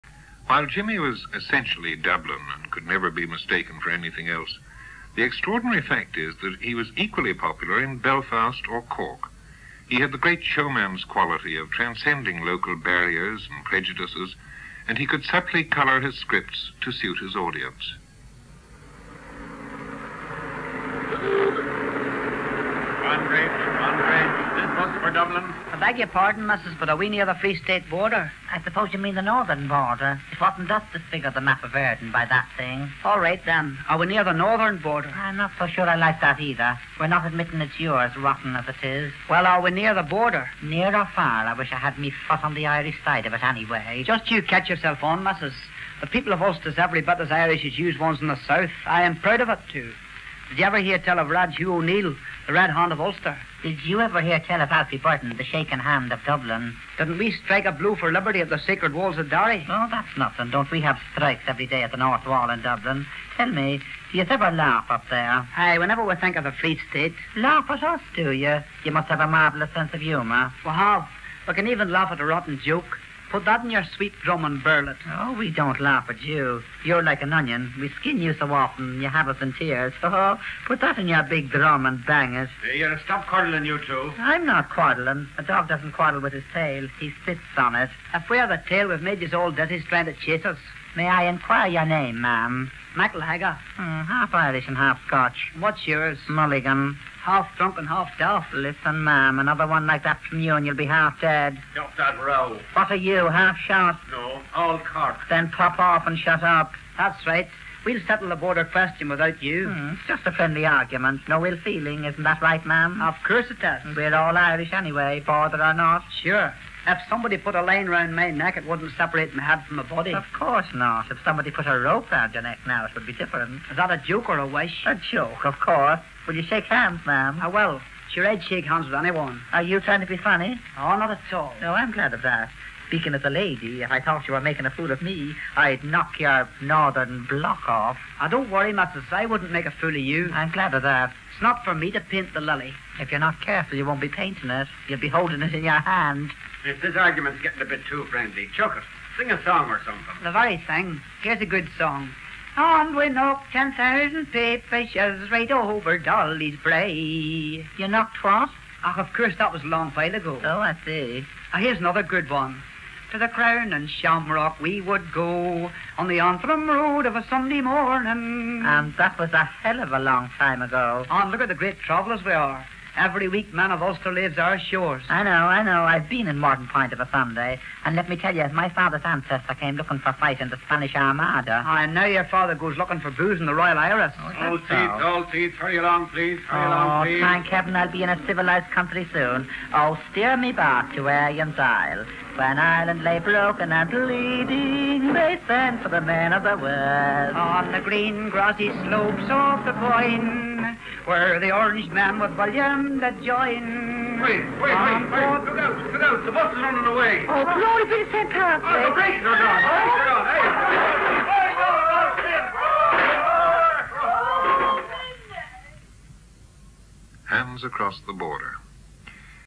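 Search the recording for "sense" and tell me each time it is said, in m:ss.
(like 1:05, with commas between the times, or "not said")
1:09.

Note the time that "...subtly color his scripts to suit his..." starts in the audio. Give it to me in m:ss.
0:15.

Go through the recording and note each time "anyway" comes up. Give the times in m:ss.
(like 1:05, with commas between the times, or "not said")
0:43, 1:54.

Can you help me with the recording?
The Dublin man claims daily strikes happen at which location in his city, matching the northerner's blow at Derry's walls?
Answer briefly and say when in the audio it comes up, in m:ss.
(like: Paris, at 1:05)
North Wall, at 1:01.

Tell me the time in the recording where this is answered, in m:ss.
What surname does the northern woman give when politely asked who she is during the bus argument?
1:32.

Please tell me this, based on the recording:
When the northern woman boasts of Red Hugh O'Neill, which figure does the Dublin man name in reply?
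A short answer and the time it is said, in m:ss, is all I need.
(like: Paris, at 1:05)
Alfie Byrne, at 0:54.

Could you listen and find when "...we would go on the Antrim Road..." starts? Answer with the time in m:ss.
2:44.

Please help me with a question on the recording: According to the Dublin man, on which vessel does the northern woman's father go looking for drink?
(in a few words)
Royal Iris.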